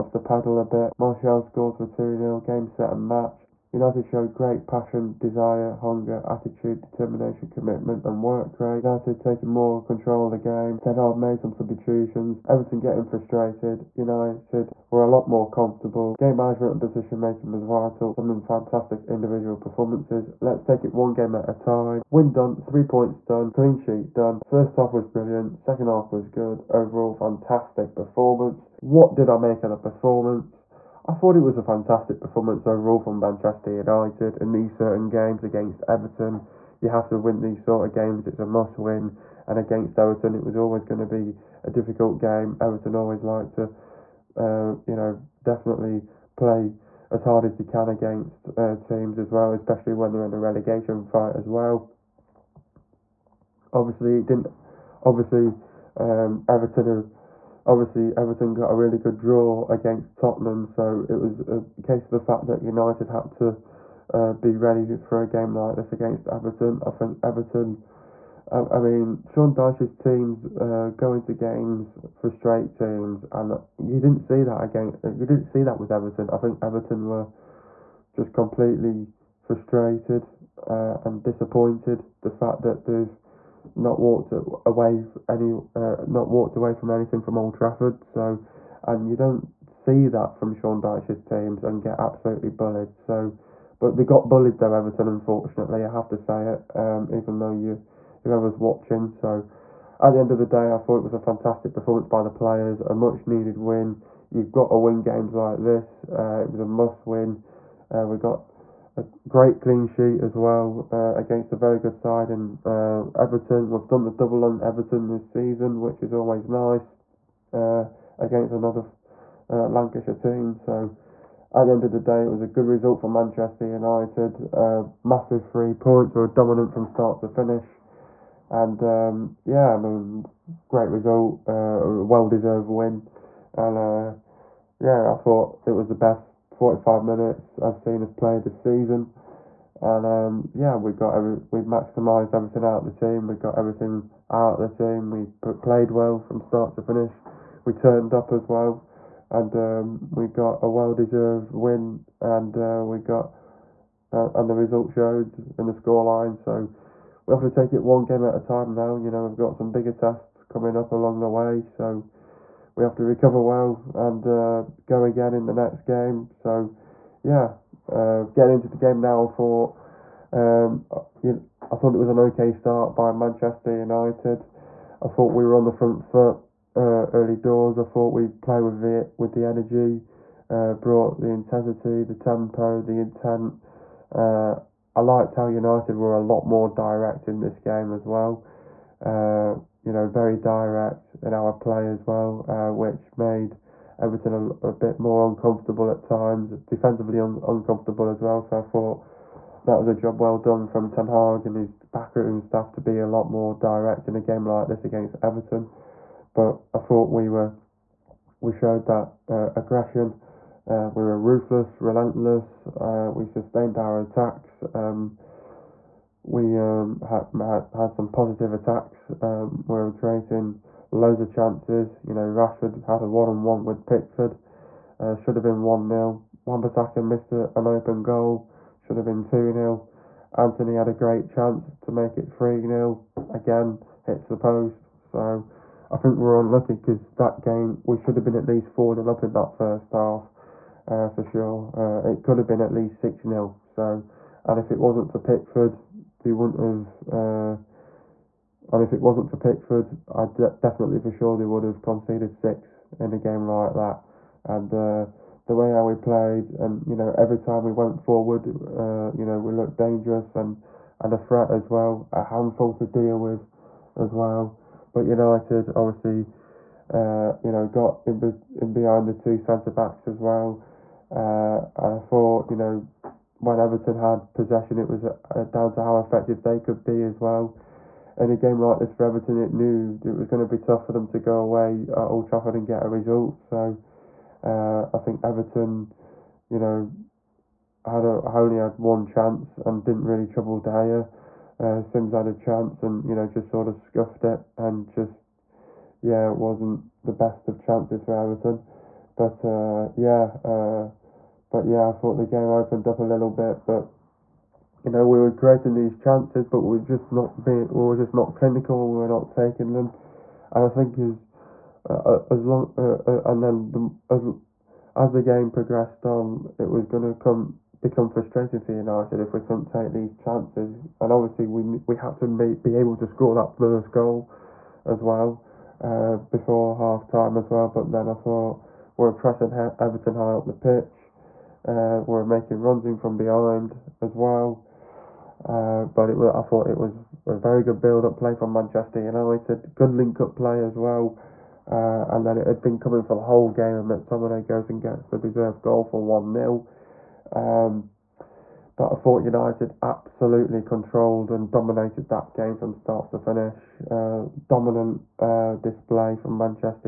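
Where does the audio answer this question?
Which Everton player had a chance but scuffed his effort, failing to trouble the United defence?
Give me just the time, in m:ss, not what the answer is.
4:51.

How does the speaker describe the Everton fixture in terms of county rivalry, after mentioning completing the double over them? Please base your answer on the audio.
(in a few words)
Lancashire team.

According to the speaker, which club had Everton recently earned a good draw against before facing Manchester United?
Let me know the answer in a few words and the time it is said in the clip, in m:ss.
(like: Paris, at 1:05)
Tottenham, at 1:00.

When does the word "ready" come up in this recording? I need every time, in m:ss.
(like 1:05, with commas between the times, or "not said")
1:04.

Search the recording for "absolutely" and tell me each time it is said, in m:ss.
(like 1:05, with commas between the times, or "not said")
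1:31, 5:49.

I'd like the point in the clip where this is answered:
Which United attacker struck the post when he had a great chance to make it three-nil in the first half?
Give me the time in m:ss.
3:50.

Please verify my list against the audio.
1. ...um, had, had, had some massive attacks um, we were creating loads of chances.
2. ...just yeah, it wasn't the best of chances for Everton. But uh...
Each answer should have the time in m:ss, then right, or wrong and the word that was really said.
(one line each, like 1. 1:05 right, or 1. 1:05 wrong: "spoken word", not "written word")
1. 3:36 wrong: "positive", not "massive"
2. 4:54 right.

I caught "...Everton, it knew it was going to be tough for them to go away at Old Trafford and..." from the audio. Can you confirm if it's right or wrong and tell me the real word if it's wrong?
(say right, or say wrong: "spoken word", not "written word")
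right.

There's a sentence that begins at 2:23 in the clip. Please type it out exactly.
We got everything out of the team.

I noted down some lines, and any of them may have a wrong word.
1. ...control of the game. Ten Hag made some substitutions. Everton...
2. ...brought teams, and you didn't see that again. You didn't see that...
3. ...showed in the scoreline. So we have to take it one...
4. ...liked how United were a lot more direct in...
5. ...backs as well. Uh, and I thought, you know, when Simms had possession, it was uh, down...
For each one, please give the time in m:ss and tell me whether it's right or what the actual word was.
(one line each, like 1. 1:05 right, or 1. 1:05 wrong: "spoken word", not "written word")
1. 0:09 right
2. 1:12 wrong: "straight", not "brought"
3. 2:34 right
4. 3:04 right
5. 4:29 wrong: "Everton", not "Simms".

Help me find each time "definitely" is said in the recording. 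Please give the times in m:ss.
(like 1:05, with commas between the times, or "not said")
0:45, 4:10.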